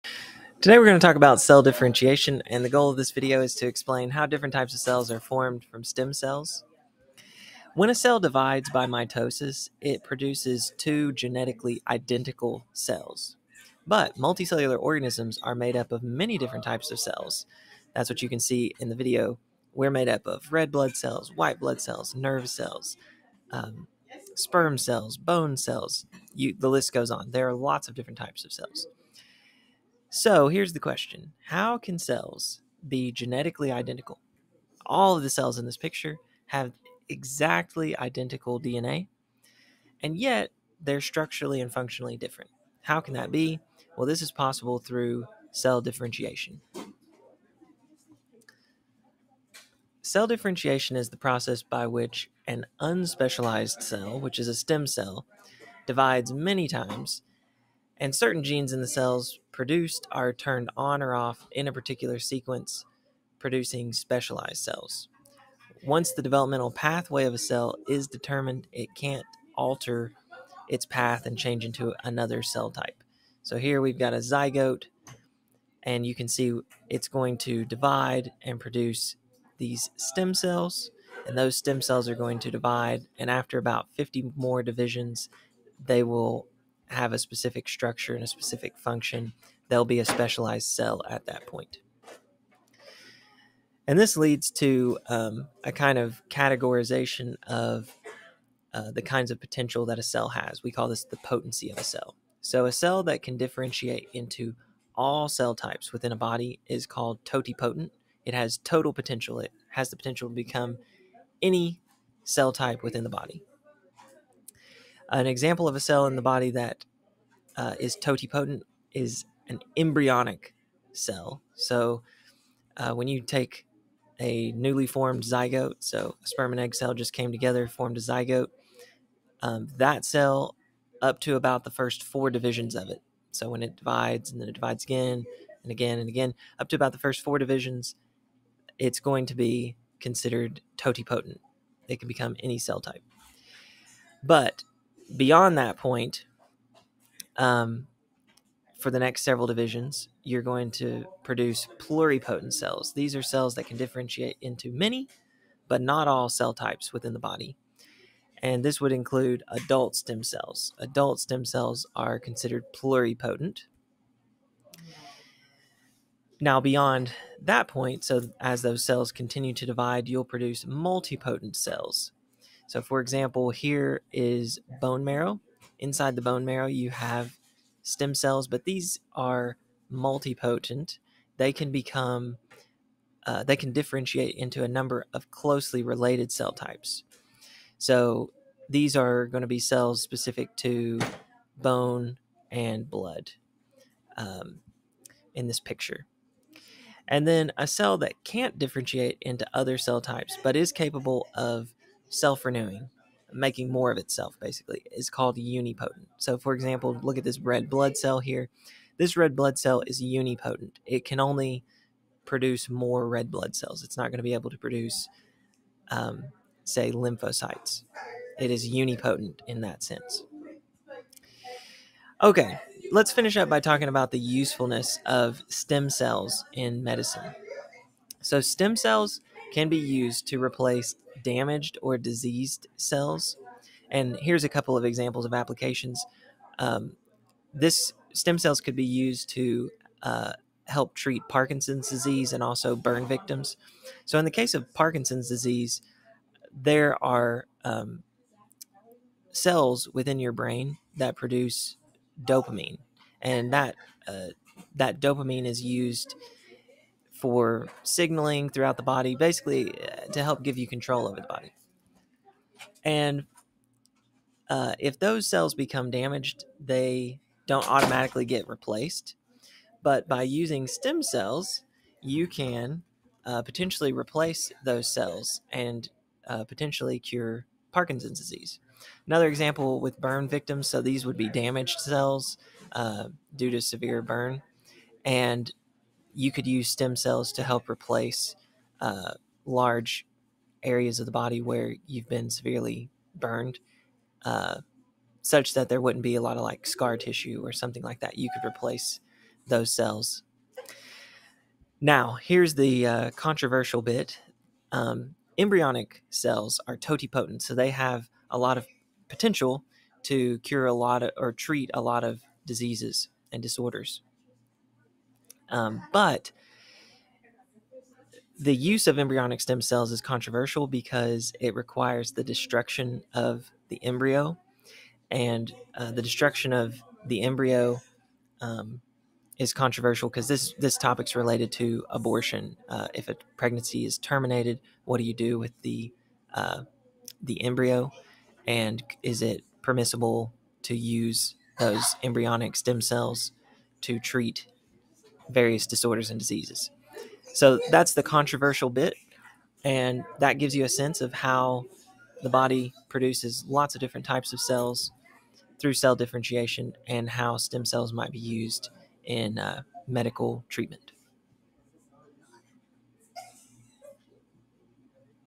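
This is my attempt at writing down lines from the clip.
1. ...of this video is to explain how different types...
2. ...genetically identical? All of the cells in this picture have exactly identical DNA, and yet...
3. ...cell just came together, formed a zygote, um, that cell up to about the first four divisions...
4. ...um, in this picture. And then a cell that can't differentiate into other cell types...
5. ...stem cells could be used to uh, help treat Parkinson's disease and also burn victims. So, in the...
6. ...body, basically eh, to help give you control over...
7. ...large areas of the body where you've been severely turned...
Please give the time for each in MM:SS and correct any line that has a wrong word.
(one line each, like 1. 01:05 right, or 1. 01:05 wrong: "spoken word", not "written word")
1. 00:02 right
2. 00:33 right
3. 02:06 right
4. 03:14 right
5. 03:58 right
6. 04:18 right
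7. 04:49 wrong: "burned", not "turned".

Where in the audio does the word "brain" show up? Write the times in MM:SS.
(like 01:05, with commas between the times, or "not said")
04:10.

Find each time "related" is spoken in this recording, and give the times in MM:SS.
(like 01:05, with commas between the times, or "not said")
03:05, 05:31.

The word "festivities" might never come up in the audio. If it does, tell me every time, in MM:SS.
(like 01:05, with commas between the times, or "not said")
not said.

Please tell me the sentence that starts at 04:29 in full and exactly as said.
But by using stem cells, you can uh, potentially replace those cells and uh, potentially cure Parkinson's disease.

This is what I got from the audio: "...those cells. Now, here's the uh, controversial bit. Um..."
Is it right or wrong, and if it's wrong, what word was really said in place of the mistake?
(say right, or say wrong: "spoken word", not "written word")
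right.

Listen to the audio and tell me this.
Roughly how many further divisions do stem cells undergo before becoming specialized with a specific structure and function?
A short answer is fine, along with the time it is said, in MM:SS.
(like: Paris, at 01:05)
50, at 01:23.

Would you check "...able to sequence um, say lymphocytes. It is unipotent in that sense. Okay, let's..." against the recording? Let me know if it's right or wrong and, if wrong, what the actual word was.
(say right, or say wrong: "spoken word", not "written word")
wrong: "produce", not "sequence".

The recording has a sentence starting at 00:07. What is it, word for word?
When a cell divides by mitosis, it produces two genetically identical cells.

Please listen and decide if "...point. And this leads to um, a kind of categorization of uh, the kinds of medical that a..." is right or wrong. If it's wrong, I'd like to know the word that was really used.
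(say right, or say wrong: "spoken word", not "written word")
wrong: "potential", not "medical".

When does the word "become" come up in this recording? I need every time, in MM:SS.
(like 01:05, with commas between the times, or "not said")
01:50, 02:22, 03:01, 04:25.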